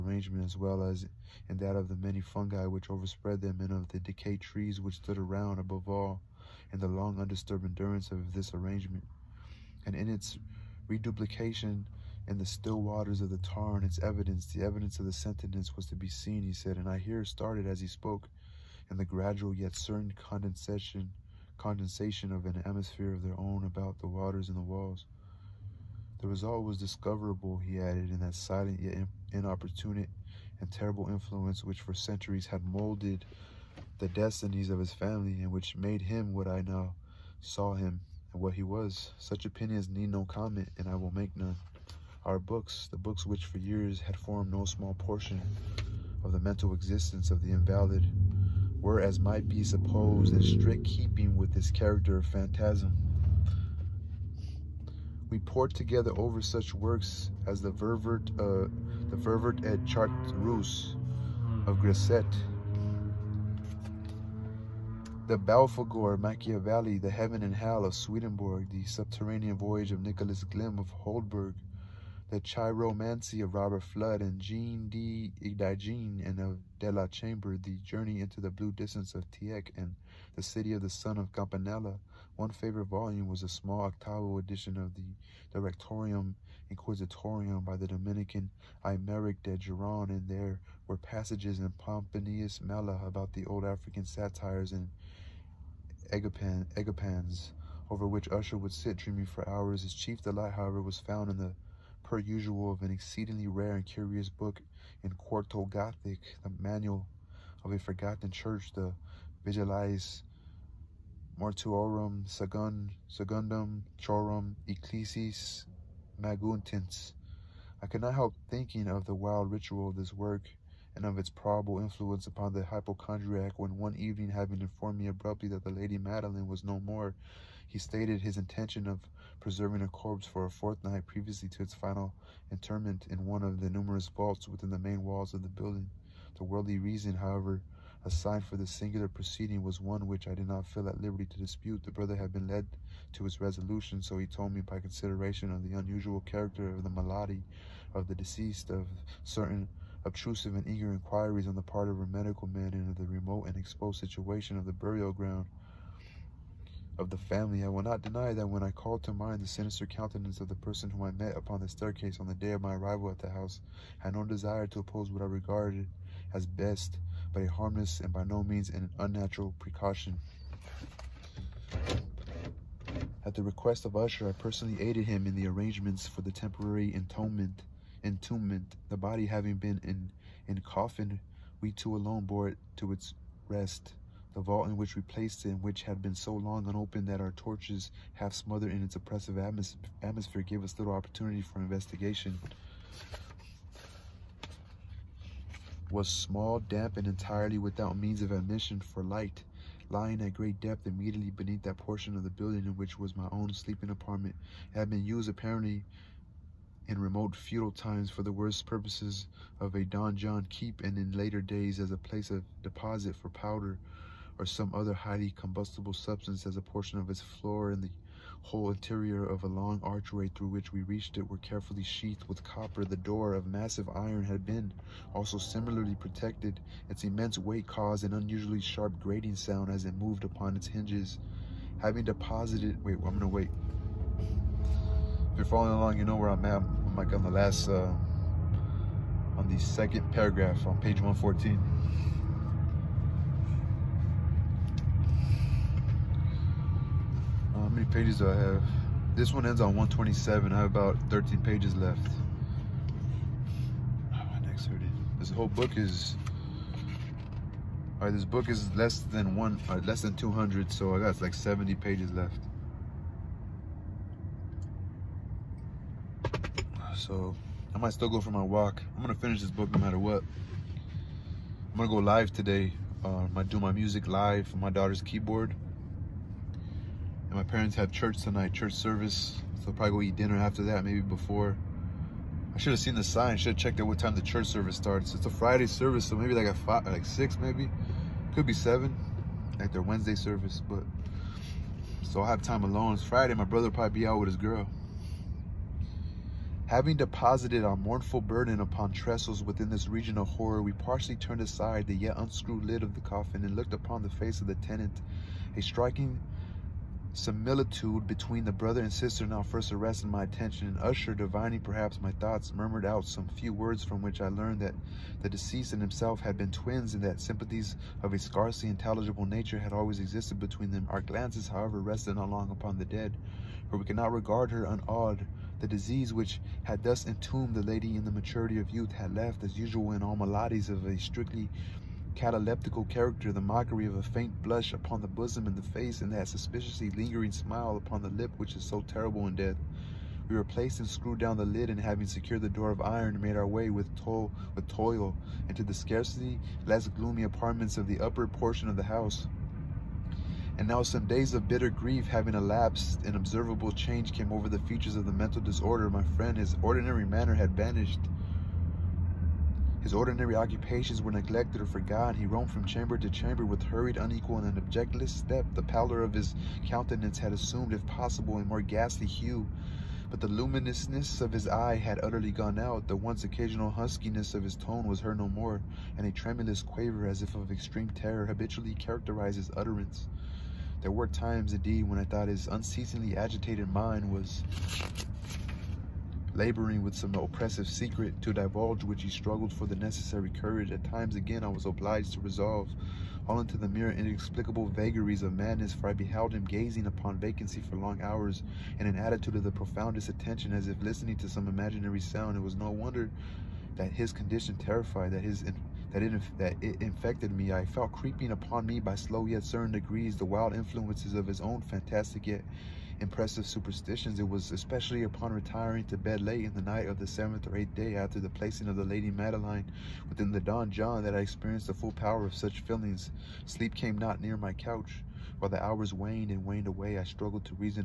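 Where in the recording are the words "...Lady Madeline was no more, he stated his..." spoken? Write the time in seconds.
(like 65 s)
125 s.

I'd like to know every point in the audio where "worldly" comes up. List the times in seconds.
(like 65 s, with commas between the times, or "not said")
136 s.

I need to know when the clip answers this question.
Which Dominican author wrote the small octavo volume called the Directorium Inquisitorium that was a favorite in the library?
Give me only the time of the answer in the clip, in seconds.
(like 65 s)
88 s.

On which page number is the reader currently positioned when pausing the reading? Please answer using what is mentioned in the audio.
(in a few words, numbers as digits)
114.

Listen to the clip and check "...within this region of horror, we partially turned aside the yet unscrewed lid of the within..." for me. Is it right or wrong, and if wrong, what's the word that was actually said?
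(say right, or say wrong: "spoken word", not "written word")
wrong: "coffin", not "within".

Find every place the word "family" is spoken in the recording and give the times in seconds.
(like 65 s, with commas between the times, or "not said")
34 s, 157 s.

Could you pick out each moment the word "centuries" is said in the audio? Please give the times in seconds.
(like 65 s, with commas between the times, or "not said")
31 s.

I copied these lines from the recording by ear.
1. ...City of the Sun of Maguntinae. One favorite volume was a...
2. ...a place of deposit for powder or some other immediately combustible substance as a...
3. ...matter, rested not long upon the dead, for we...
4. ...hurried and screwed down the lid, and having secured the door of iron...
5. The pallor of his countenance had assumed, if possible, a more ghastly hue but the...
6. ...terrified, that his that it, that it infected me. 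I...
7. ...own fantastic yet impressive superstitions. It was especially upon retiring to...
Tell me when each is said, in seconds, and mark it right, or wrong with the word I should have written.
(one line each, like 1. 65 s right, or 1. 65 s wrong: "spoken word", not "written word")
1. 80 s wrong: "Campanella", not "Maguntinae"
2. 211 s wrong: "highly", not "immediately"
3. 321 s wrong: "however", not "matter"
4. 340 s wrong: "replaced", not "hurried"
5. 365 s right
6. 404 s right
7. 411 s right.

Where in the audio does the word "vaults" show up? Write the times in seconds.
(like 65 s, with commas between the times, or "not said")
134 s, 184 s.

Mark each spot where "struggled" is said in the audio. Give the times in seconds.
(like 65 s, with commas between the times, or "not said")
389 s, 427 s.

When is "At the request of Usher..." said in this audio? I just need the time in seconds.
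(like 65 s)
173 s.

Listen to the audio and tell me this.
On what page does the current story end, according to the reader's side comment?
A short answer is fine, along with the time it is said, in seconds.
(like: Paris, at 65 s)
127, at 249 s.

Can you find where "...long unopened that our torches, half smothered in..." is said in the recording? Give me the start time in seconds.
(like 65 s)
186 s.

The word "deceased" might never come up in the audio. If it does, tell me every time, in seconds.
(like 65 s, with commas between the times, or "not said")
148 s, 315 s.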